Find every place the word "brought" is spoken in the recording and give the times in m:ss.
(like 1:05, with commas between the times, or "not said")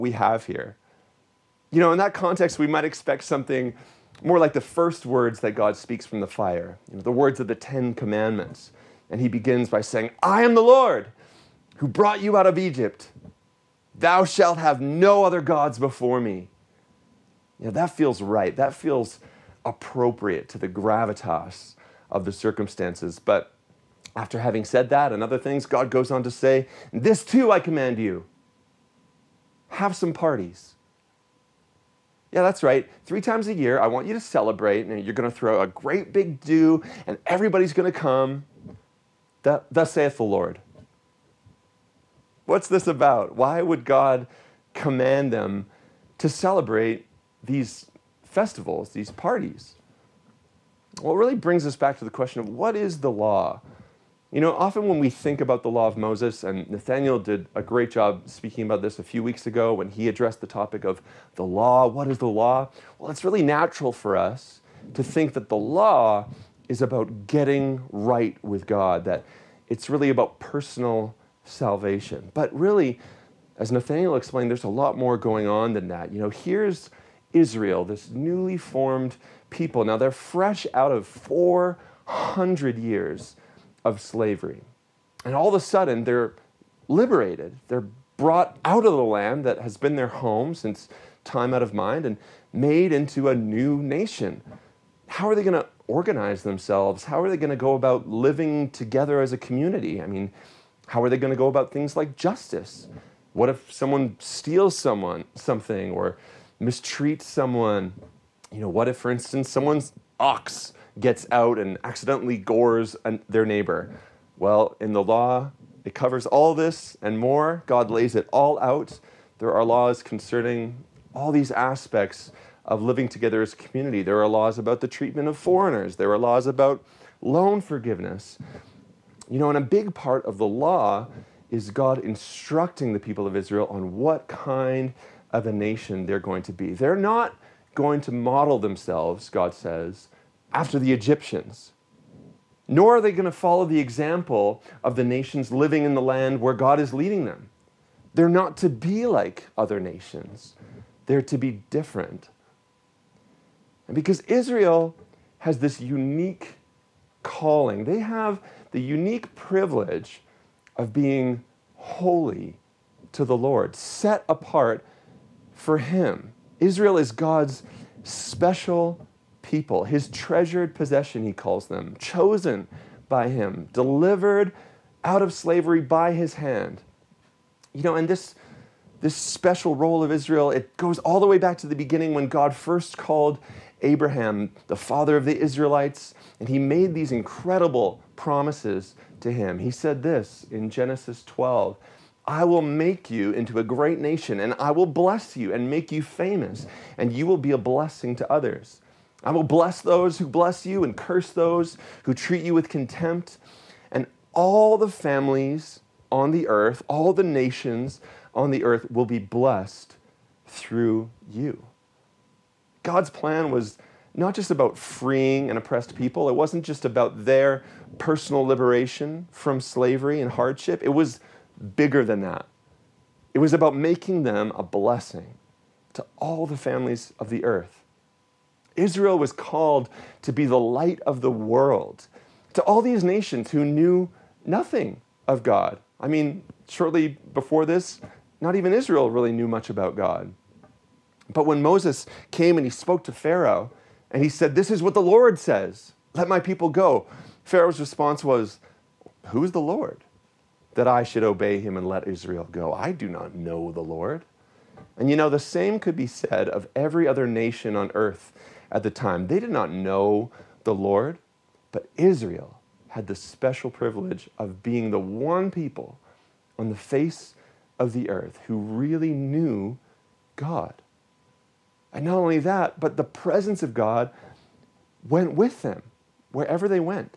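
0:11, 1:28.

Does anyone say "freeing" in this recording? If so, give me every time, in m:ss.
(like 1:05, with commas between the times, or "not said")
3:34.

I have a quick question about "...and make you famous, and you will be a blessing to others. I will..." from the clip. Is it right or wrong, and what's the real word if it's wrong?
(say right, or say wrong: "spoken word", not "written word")
right.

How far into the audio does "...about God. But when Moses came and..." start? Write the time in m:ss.
3:59.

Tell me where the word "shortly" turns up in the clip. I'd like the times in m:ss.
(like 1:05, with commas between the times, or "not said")
3:56.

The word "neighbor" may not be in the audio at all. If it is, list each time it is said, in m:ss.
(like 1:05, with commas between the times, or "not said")
1:53.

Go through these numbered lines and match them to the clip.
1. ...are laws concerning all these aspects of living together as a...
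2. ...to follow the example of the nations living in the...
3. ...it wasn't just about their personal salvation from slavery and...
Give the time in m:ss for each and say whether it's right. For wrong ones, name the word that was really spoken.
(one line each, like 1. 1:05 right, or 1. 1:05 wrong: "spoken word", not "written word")
1. 1:59 right
2. 2:23 right
3. 3:36 wrong: "liberation", not "salvation".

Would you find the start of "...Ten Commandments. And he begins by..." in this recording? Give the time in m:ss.
0:07.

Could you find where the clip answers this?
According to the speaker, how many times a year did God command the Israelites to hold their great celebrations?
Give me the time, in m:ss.
0:33.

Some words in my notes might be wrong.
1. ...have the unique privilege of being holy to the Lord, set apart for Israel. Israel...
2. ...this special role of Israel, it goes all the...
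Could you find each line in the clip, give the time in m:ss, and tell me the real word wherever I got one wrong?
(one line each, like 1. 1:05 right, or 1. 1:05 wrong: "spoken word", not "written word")
1. 2:38 wrong: "Him", not "Israel"
2. 2:59 right.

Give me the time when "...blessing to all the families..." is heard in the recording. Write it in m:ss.
3:44.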